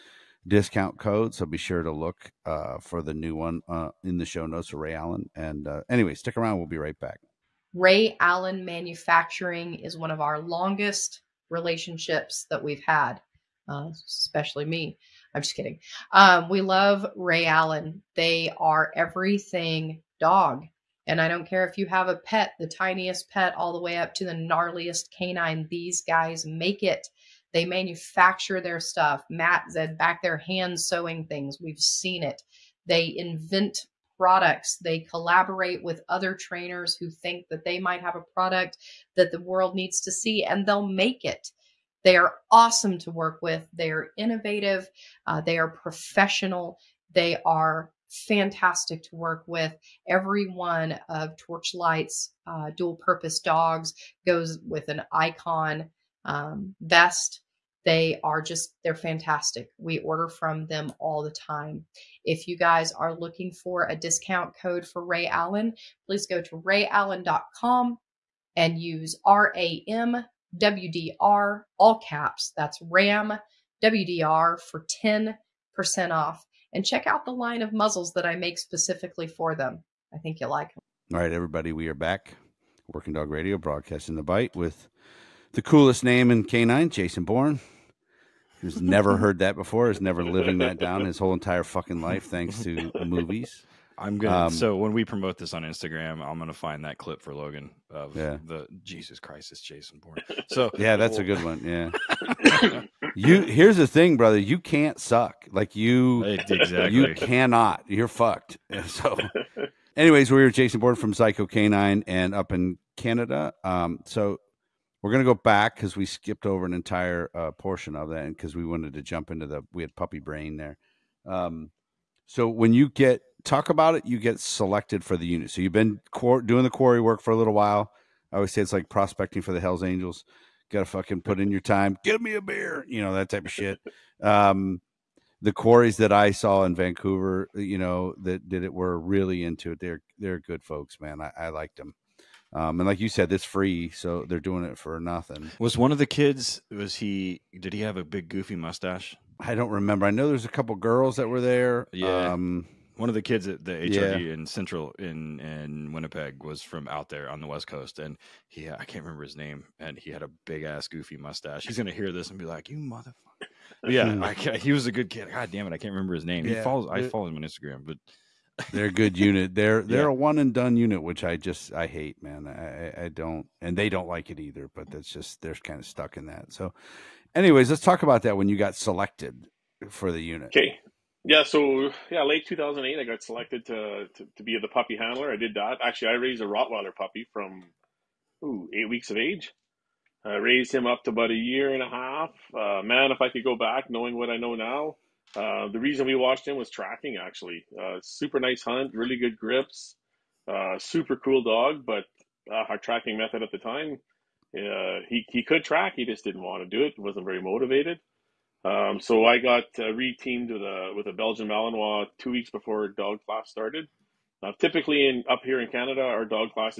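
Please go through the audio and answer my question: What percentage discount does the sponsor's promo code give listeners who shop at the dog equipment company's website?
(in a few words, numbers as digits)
10%.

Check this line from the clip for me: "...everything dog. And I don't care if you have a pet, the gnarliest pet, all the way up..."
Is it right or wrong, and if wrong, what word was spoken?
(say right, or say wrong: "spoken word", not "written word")
wrong: "tiniest", not "gnarliest".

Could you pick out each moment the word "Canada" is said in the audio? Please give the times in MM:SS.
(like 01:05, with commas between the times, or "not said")
01:52, 03:35.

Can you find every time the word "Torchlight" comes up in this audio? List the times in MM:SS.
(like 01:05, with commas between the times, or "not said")
00:51.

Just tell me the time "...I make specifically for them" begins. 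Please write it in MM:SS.
01:18.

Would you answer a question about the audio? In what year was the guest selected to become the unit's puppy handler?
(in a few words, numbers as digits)
2008.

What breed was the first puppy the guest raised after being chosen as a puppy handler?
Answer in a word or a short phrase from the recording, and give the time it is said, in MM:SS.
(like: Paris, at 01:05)
Rottweiler, at 03:06.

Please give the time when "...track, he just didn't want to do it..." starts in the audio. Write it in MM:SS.
03:25.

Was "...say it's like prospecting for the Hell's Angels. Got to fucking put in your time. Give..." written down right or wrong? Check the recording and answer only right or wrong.
right.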